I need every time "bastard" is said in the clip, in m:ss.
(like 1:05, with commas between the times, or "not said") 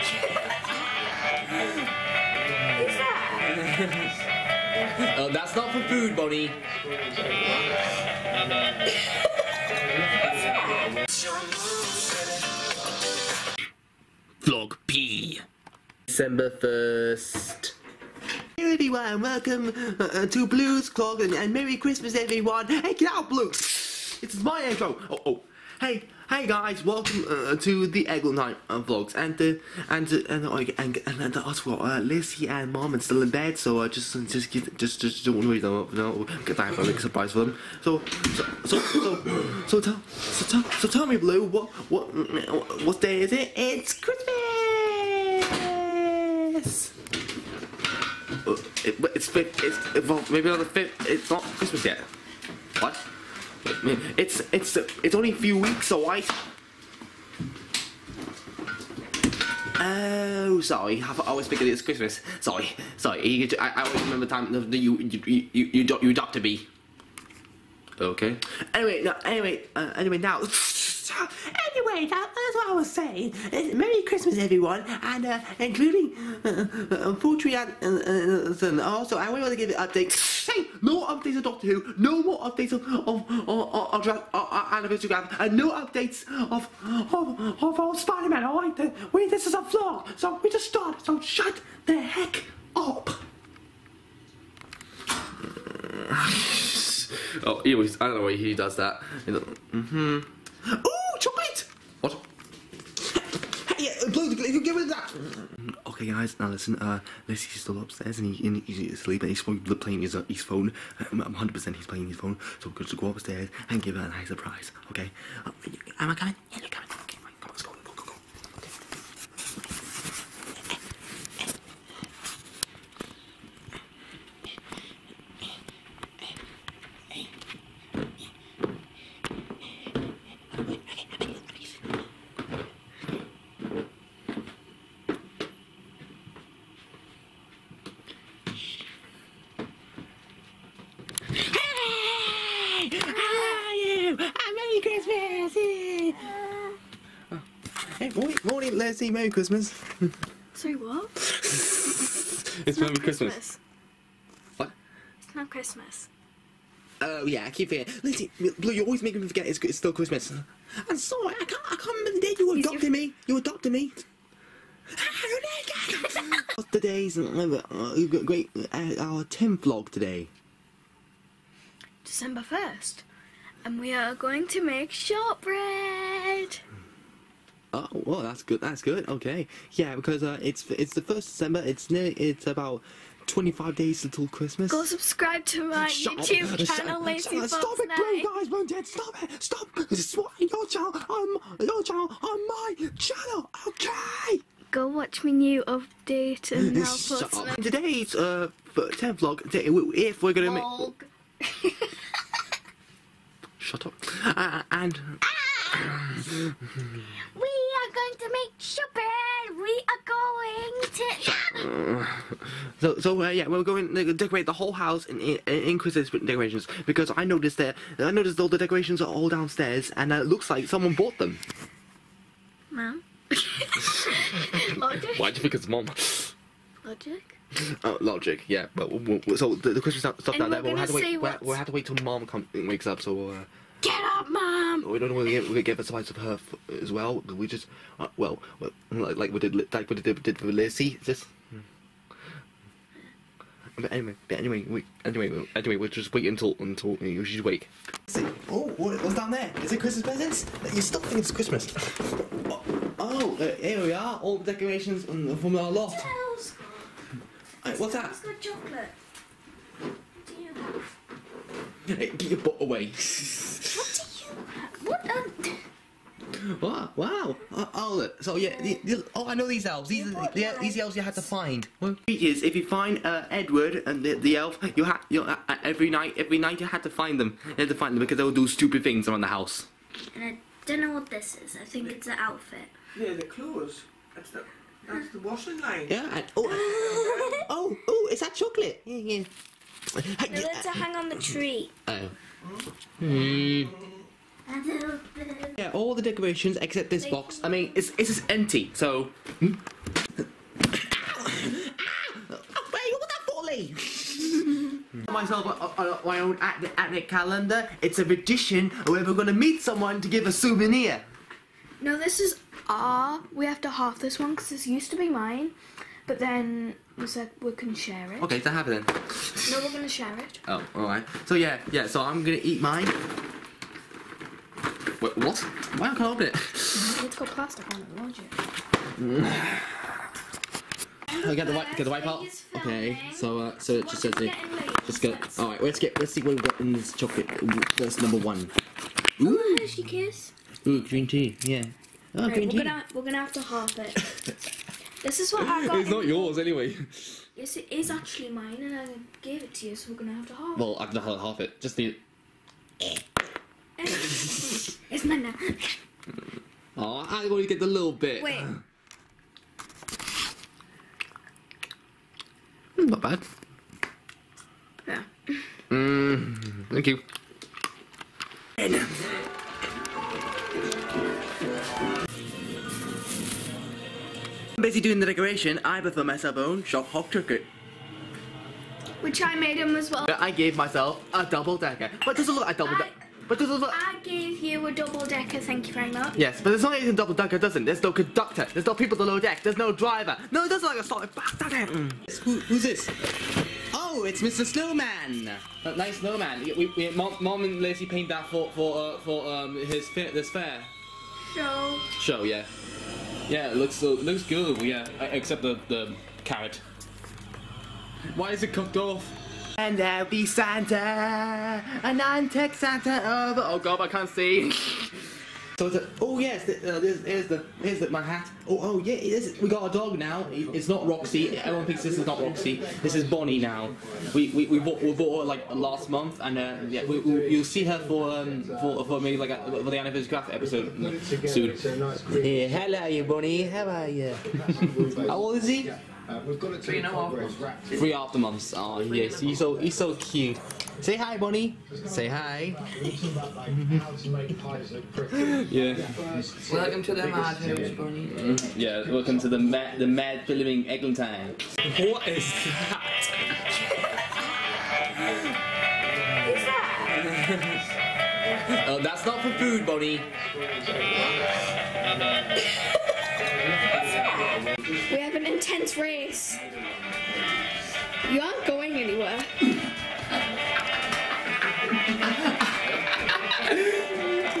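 6:31.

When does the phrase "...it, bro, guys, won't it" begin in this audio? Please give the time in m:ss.
3:07.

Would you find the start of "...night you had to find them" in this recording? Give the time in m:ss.
4:36.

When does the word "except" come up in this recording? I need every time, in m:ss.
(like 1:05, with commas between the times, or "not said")
4:56, 6:45.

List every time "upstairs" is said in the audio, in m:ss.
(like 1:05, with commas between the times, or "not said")
1:47, 1:53.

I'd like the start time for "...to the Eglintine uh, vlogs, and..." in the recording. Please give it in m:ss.
0:27.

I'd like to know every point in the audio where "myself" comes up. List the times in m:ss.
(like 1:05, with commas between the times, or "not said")
5:05, 6:16, 6:20.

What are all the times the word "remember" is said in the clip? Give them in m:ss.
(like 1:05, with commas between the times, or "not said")
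1:04, 2:41.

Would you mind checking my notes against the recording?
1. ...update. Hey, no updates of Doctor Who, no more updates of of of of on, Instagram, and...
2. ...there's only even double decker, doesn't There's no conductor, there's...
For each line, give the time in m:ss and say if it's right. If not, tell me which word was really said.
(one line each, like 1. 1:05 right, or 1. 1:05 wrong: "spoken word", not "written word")
1. 1:19 right
2. 6:26 right.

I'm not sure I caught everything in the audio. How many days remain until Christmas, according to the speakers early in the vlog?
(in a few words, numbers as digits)
25.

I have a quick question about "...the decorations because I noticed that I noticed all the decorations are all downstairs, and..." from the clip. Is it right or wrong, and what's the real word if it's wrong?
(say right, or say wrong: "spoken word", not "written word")
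right.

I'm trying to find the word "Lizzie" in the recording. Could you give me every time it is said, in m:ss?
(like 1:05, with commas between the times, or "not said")
0:31, 2:38, 4:00, 6:37.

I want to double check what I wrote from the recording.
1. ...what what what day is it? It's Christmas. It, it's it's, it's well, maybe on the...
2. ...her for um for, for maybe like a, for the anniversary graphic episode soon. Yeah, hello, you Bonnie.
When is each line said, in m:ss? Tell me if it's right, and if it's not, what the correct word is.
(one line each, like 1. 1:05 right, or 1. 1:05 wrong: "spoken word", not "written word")
1. 0:41 right
2. 7:07 right.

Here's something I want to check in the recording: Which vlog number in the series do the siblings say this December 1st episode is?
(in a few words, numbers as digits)
10th.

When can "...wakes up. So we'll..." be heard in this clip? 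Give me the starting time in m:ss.
3:52.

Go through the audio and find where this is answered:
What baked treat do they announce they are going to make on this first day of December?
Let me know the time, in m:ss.
2:54.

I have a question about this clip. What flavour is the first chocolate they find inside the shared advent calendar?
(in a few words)
Green tea.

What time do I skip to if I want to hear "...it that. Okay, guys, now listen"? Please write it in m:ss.
1:44.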